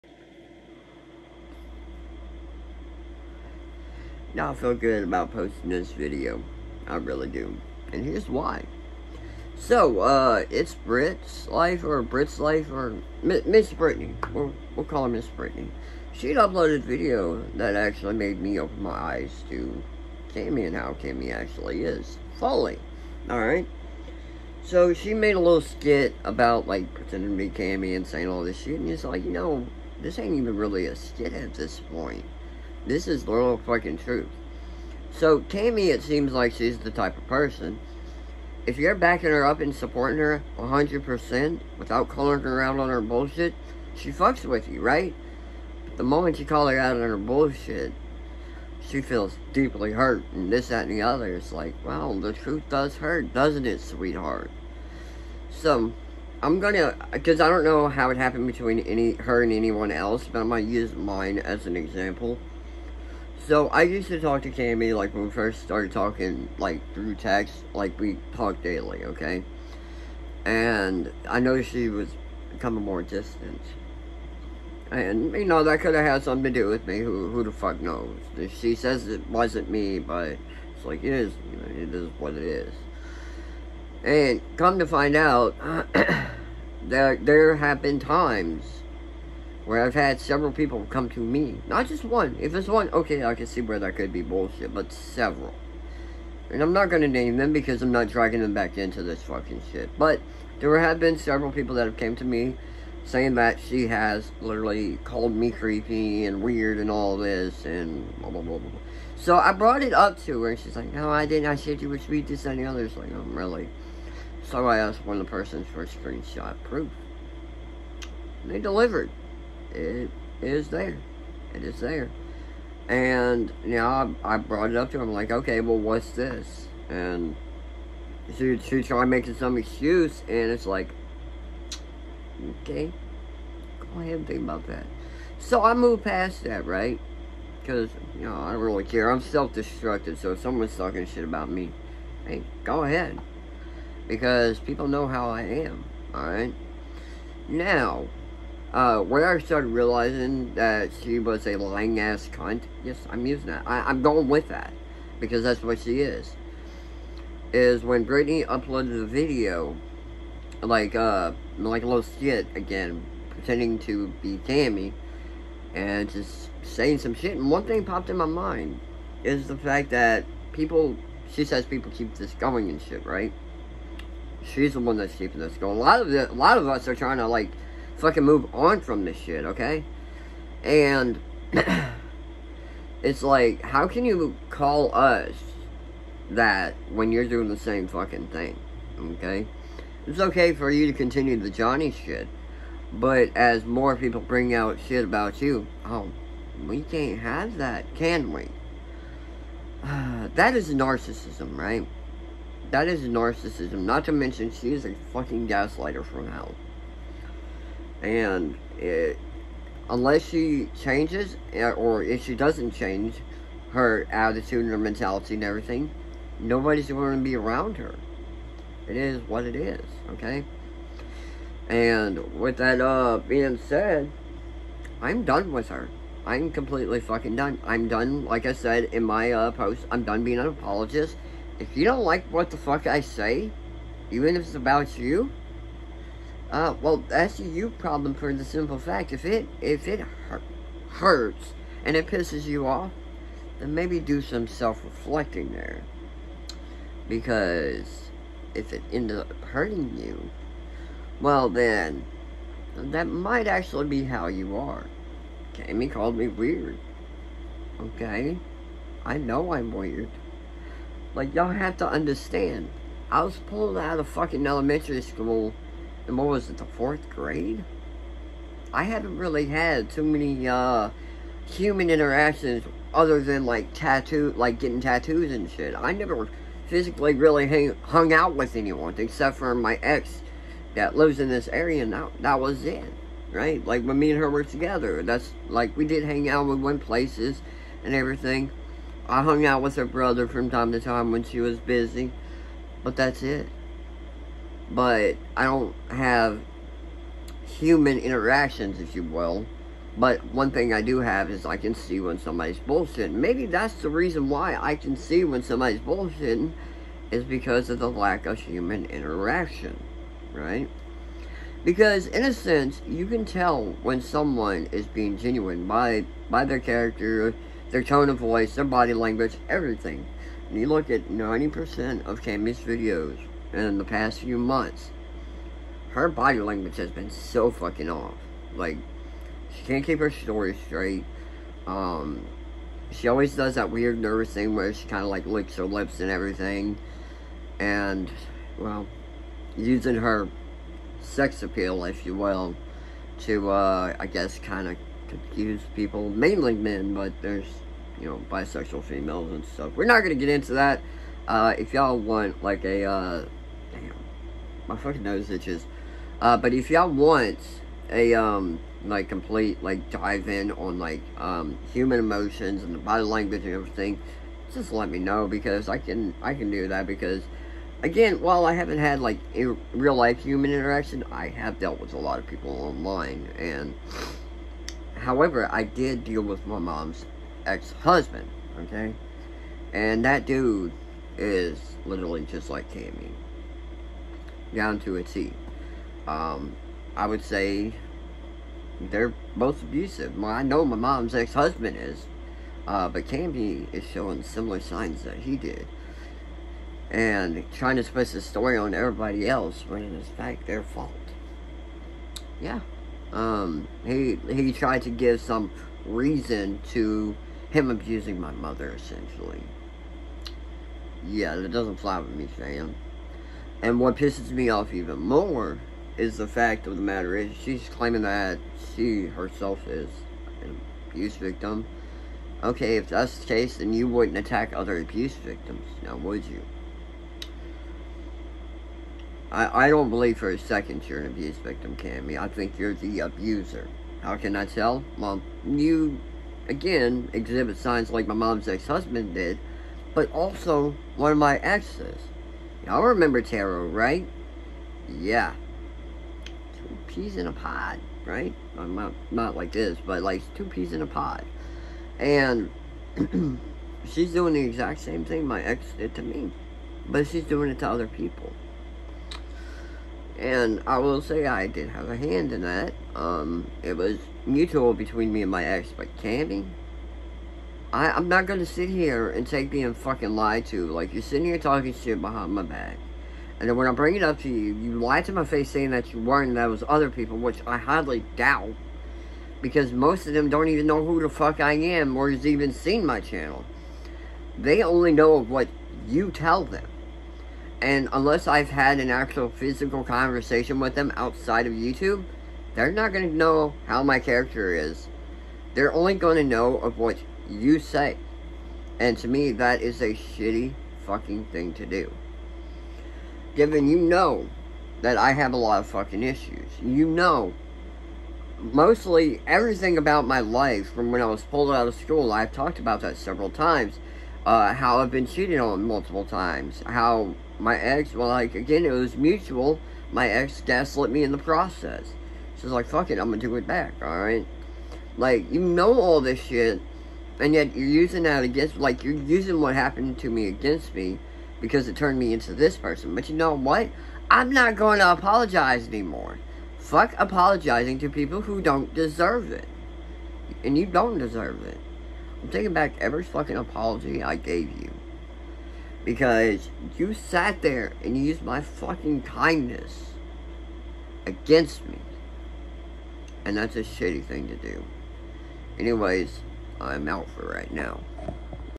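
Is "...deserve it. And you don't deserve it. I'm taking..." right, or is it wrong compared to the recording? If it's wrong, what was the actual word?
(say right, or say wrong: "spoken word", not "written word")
right.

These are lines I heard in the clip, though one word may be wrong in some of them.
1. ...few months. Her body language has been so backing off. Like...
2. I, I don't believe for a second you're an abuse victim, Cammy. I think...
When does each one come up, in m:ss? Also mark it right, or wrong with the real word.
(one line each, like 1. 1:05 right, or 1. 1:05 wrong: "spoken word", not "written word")
1. 5:24 wrong: "fucking", not "backing"
2. 7:09 right.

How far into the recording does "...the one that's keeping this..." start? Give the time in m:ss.
2:54.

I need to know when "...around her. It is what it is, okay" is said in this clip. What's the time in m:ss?
3:37.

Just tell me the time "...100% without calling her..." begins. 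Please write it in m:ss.
0:40.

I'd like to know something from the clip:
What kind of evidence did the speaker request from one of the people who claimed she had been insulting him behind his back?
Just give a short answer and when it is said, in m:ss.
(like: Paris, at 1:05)
Screenshot proof, at 1:55.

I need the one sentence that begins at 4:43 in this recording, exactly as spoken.
Like when me and her were together, that's like we did hang out.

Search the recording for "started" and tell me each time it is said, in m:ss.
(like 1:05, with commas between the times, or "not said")
1:05, 2:29.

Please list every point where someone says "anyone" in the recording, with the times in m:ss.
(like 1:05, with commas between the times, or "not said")
0:59, 4:38.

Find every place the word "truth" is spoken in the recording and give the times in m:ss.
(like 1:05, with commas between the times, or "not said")
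0:33, 0:52.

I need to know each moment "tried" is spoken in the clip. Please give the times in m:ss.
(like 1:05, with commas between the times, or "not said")
2:08, 6:44.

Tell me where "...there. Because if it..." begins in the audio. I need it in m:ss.
4:05.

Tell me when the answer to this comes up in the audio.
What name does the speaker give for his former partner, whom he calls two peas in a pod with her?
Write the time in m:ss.
7:23.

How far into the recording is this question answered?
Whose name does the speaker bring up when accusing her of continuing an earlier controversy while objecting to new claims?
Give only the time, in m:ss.
3:11.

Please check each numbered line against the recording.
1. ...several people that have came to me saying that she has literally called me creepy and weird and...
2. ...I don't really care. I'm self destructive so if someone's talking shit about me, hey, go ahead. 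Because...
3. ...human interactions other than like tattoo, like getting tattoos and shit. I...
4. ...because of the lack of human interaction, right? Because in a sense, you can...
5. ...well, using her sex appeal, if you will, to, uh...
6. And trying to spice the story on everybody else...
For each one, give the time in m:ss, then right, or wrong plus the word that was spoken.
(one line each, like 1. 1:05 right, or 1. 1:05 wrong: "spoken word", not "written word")
1. 1:41 right
2. 2:18 right
3. 4:31 right
4. 5:07 right
5. 5:38 right
6. 6:36 right.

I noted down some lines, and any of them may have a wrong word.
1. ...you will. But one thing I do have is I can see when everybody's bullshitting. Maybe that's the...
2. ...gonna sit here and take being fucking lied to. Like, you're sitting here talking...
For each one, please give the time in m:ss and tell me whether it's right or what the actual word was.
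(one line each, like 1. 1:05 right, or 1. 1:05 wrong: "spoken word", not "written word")
1. 4:58 wrong: "somebody", not "everybody"
2. 7:48 right.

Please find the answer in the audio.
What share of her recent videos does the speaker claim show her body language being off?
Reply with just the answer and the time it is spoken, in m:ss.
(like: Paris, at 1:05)
90%, at 5:21.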